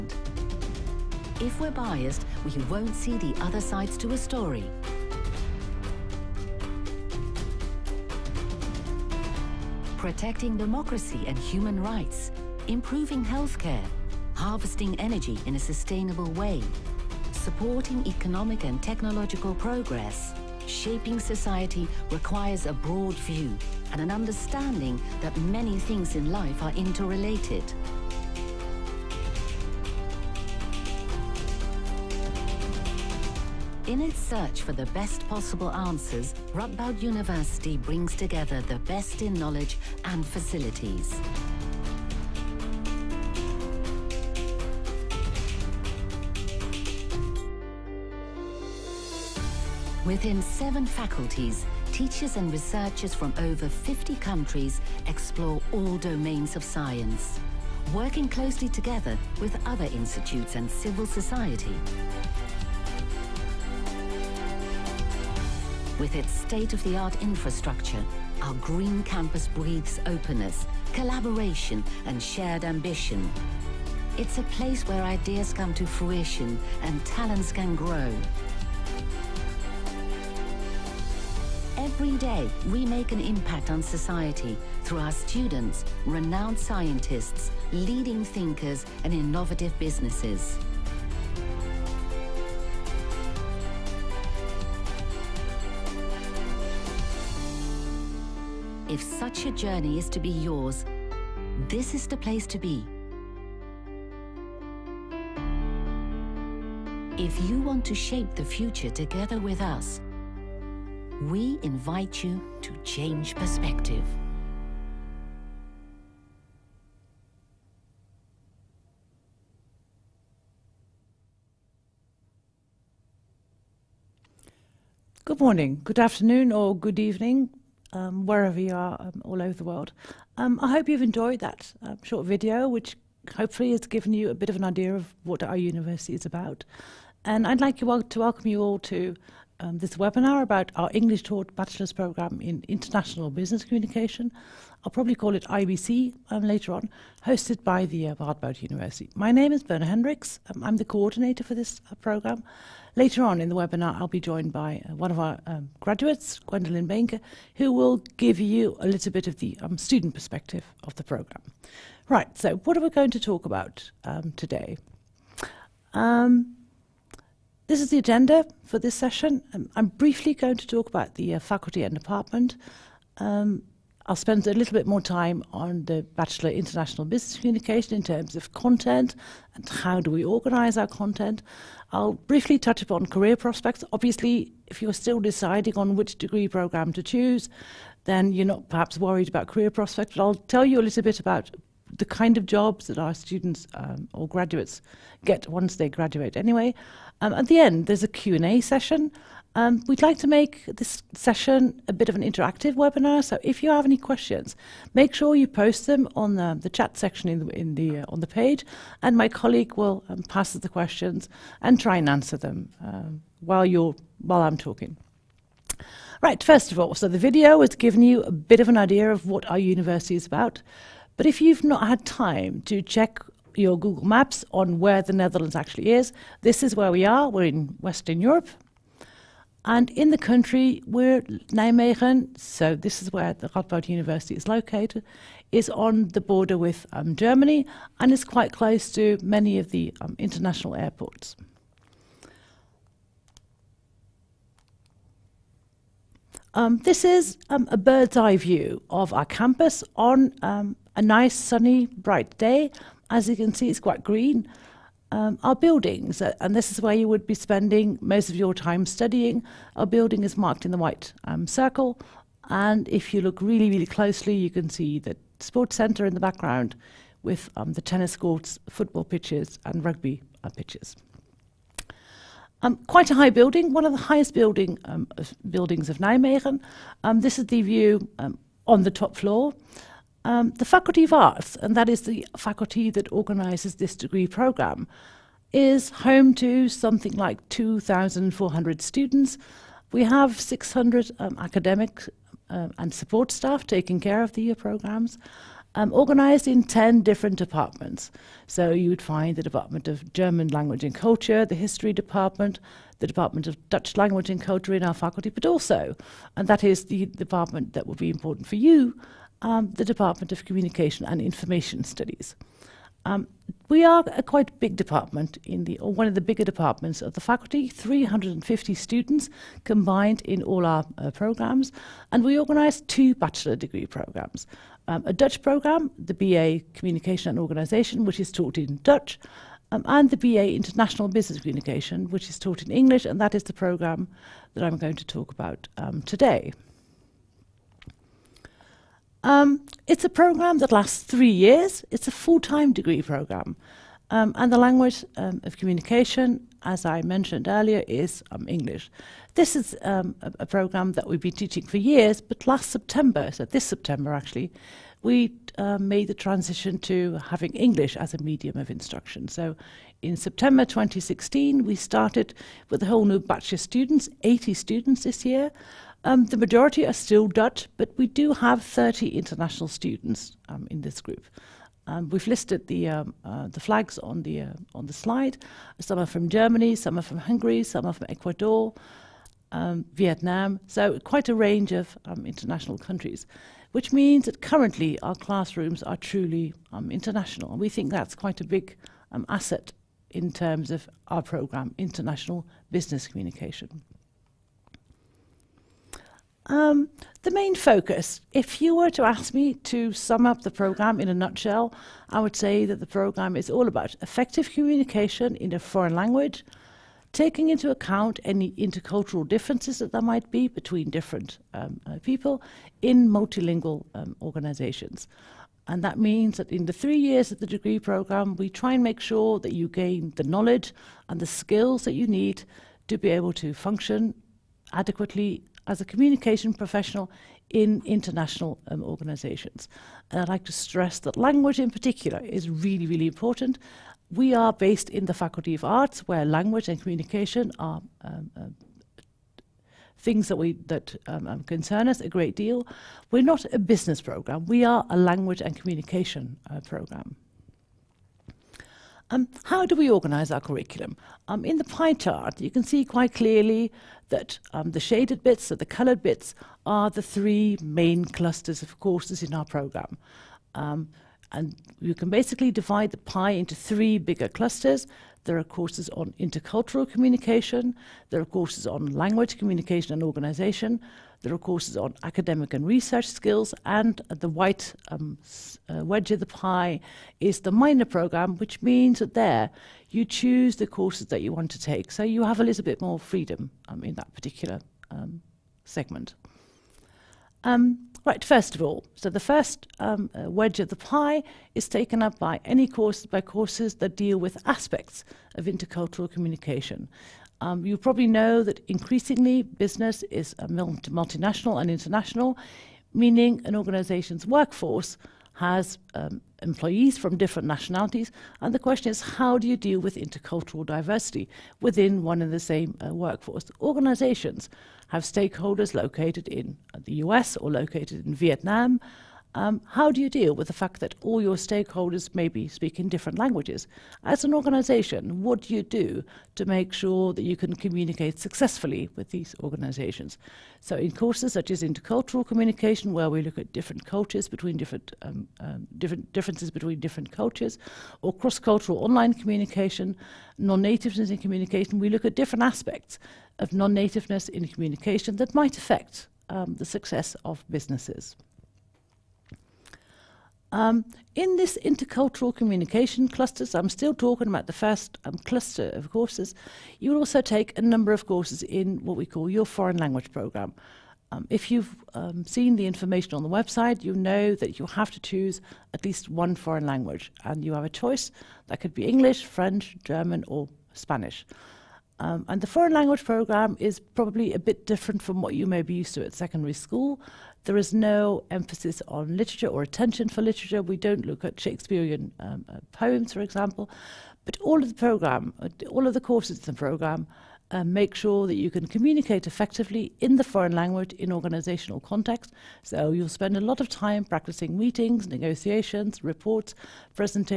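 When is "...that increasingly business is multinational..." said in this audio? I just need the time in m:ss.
8:18.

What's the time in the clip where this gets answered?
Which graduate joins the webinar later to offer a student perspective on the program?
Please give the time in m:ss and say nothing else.
2:36.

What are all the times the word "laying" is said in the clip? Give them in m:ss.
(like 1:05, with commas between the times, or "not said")
not said.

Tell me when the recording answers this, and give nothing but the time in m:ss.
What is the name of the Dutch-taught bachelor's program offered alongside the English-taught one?
5:26.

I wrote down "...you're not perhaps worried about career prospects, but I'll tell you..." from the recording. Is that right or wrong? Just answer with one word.
right.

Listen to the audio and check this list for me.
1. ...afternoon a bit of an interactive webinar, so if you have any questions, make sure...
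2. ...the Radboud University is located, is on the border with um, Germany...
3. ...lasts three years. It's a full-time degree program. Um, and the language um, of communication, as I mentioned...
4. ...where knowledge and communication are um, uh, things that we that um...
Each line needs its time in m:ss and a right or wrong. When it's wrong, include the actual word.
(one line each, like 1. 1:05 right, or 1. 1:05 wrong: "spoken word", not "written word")
1. 3:21 wrong: "session", not "afternoon"
2. 3:53 right
3. 5:40 right
4. 7:16 wrong: "language", not "knowledge".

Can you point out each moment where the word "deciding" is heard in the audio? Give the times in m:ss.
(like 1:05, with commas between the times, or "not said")
3:05.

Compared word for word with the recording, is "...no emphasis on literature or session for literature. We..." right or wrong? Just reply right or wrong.
wrong.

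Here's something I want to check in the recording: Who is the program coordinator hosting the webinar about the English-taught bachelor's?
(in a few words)
Berna Hendriks.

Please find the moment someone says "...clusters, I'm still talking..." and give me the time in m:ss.
9:13.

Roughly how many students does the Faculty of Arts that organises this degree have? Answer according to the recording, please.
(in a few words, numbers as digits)
2,400.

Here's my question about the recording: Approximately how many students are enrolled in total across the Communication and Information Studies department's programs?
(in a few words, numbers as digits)
350.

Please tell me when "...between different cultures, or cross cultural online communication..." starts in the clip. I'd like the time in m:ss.
8:56.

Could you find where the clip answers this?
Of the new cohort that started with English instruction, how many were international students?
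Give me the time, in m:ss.
6:08.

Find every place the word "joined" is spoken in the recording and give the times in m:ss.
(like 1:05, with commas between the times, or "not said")
2:34.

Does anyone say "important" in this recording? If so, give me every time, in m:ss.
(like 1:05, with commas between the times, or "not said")
5:08, 7:13.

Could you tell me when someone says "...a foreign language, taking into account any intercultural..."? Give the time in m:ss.
6:45.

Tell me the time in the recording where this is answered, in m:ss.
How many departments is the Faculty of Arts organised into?
4:56.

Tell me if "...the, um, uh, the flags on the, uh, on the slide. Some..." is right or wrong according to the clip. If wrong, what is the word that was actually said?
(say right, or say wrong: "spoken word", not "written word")
right.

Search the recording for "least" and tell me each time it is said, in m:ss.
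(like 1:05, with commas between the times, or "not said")
9:25.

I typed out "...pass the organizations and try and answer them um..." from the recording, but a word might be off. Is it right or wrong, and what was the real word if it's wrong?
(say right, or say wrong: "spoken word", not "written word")
wrong: "questions", not "organizations".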